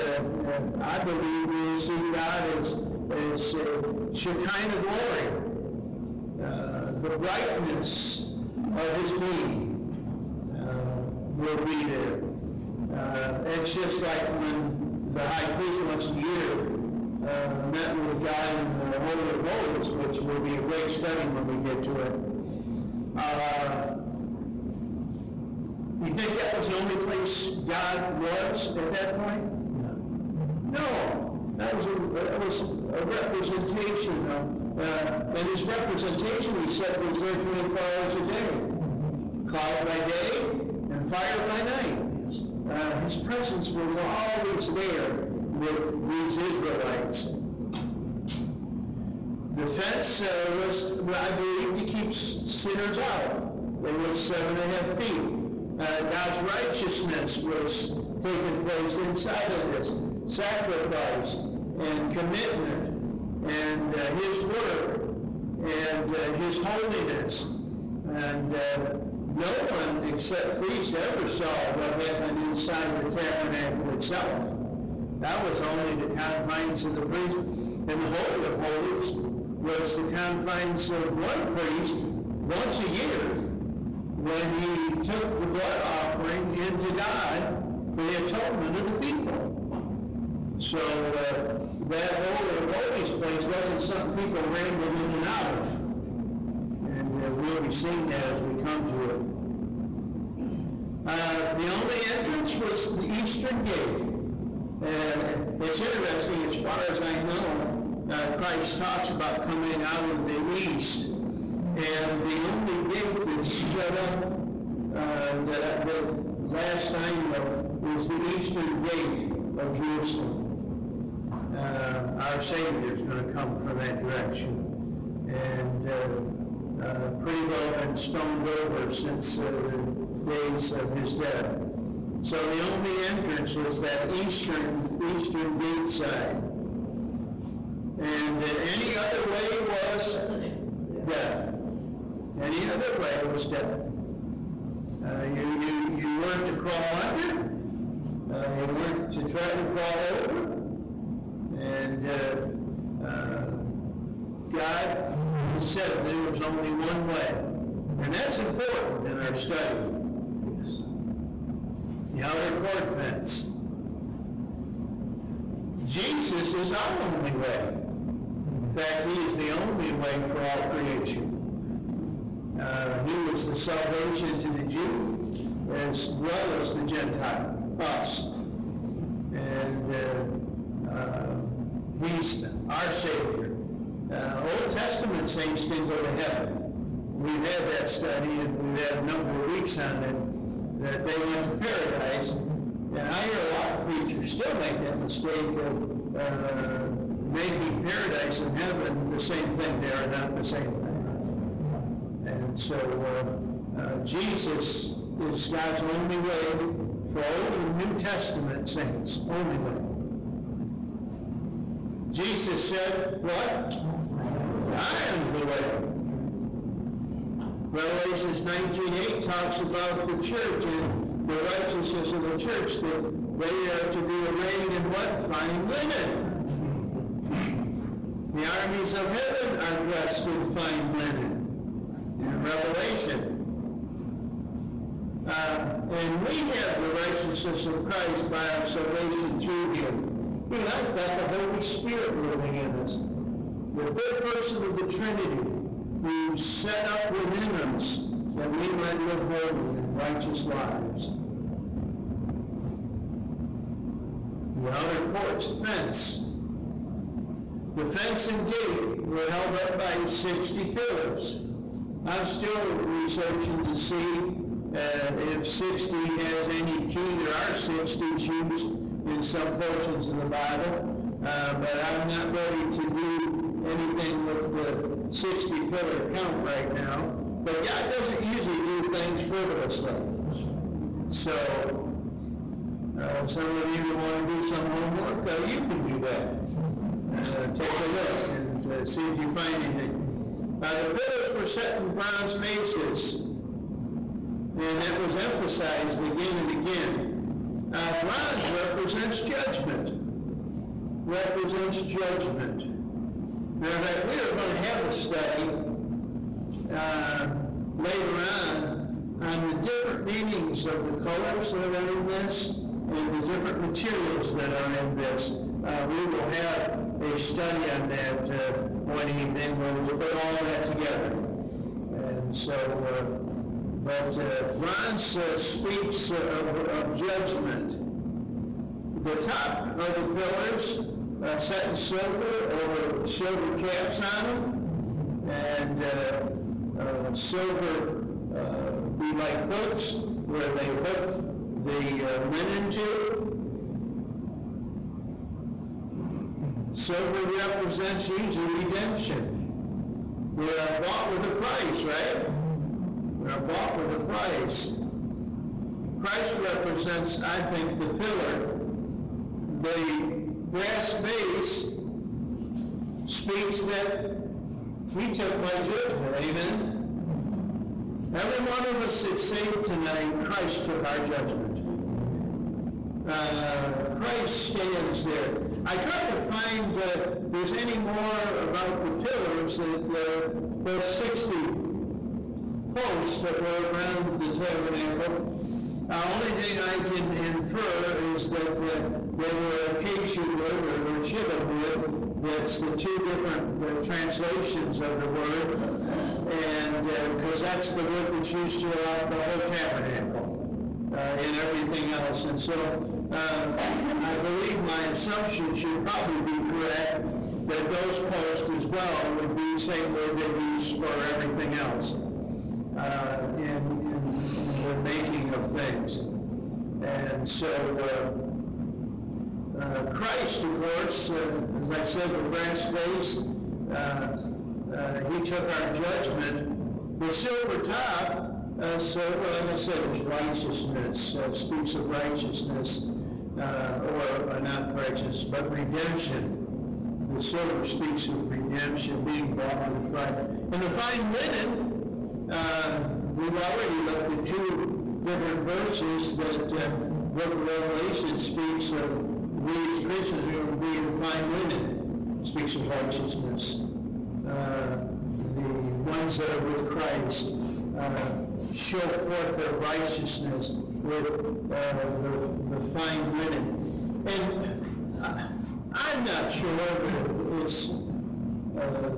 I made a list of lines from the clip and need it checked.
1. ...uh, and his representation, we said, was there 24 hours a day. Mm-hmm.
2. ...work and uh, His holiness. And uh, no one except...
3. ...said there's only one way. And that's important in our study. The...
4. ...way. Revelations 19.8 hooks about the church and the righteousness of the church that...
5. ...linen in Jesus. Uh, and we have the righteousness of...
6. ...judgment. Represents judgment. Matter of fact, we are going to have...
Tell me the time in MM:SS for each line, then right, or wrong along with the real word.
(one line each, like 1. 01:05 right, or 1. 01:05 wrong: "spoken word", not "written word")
1. 00:34 right
2. 01:04 right
3. 02:35 right
4. 03:35 wrong: "talks", not "hooks"
5. 03:50 wrong: "Revelation", not "Jesus"
6. 04:59 right.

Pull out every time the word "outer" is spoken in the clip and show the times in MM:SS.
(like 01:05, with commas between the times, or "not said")
02:42, 04:14.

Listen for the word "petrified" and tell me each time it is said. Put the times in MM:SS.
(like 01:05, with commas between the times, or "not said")
not said.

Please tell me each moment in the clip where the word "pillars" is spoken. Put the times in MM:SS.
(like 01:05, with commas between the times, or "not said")
04:20, 04:35, 04:50, 05:30, 05:57, 06:19.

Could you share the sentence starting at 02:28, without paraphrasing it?
Uh, you weren't to try to crawl over.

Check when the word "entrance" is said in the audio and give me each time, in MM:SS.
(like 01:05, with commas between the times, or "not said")
01:42, 02:13.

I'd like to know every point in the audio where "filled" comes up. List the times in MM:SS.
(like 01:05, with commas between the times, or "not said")
not said.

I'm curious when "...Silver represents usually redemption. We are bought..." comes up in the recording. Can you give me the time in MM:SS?
05:46.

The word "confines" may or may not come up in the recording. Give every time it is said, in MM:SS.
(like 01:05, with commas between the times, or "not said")
01:16, 01:20.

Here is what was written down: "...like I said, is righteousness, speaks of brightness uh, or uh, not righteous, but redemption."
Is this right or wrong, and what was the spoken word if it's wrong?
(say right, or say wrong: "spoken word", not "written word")
wrong: "righteousness", not "brightness".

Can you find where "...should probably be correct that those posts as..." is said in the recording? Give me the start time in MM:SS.
06:45.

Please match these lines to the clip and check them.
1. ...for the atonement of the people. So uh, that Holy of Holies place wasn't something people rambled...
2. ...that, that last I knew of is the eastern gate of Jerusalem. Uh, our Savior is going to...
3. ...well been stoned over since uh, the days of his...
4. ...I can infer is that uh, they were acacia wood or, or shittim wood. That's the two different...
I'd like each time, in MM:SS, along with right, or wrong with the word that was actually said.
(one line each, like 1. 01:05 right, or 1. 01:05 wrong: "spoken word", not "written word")
1. 01:27 right
2. 01:55 right
3. 02:07 right
4. 06:26 right.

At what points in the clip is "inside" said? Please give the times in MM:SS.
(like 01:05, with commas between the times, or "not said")
00:58, 01:12.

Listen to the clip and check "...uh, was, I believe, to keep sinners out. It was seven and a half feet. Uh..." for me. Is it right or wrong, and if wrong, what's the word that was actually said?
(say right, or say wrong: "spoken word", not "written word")
right.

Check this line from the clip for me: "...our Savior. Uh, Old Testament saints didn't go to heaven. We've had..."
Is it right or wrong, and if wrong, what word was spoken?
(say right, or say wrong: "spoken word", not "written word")
right.